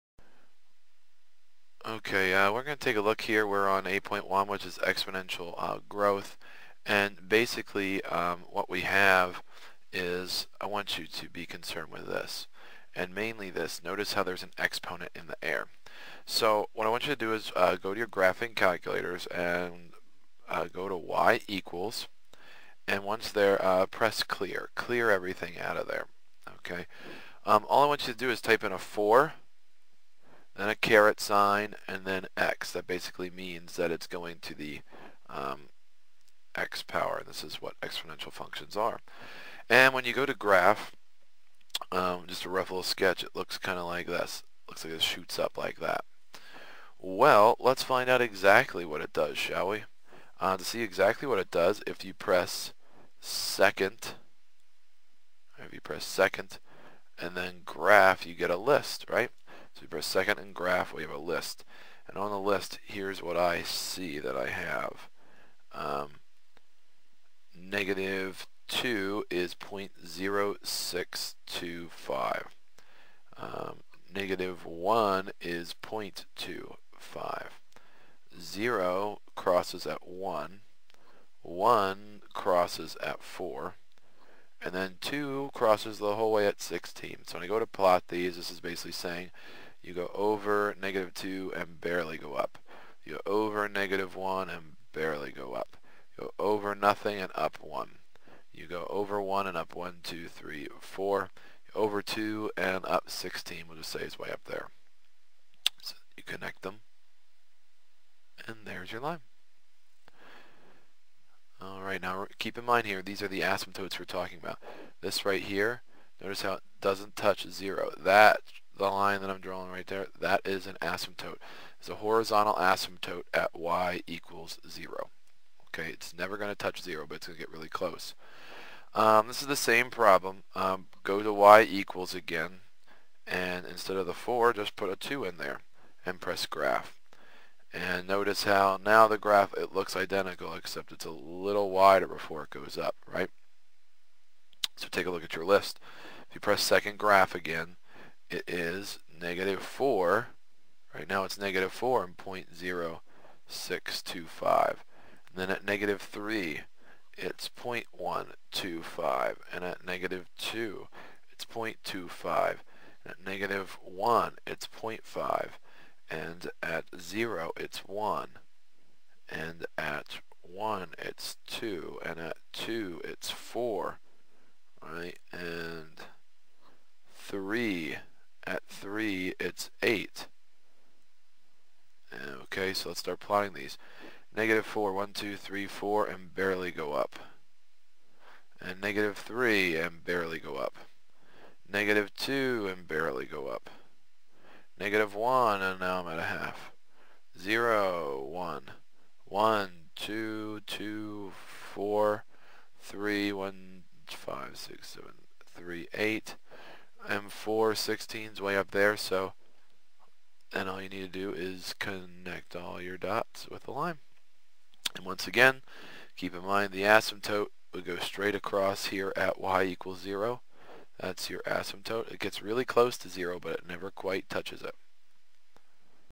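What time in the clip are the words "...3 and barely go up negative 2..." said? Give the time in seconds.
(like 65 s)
189 s.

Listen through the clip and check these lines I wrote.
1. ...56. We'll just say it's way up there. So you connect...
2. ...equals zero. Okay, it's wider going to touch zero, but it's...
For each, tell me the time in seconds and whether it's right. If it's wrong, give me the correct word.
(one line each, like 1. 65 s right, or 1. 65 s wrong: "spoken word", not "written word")
1. 103 s wrong: "16", not "56"
2. 124 s wrong: "never", not "wider".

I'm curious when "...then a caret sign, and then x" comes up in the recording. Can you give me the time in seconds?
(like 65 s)
30 s.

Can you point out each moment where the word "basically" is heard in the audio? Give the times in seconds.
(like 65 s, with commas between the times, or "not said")
7 s, 32 s, 88 s.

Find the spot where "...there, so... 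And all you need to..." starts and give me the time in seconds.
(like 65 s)
208 s.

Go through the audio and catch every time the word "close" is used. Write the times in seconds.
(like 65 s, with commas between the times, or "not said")
127 s, 222 s.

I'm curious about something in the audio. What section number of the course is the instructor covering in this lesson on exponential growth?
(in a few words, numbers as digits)
8.1.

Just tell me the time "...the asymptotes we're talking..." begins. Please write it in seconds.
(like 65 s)
113 s.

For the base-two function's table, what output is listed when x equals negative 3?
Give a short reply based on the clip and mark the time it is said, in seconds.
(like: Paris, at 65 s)
0.125, at 157 s.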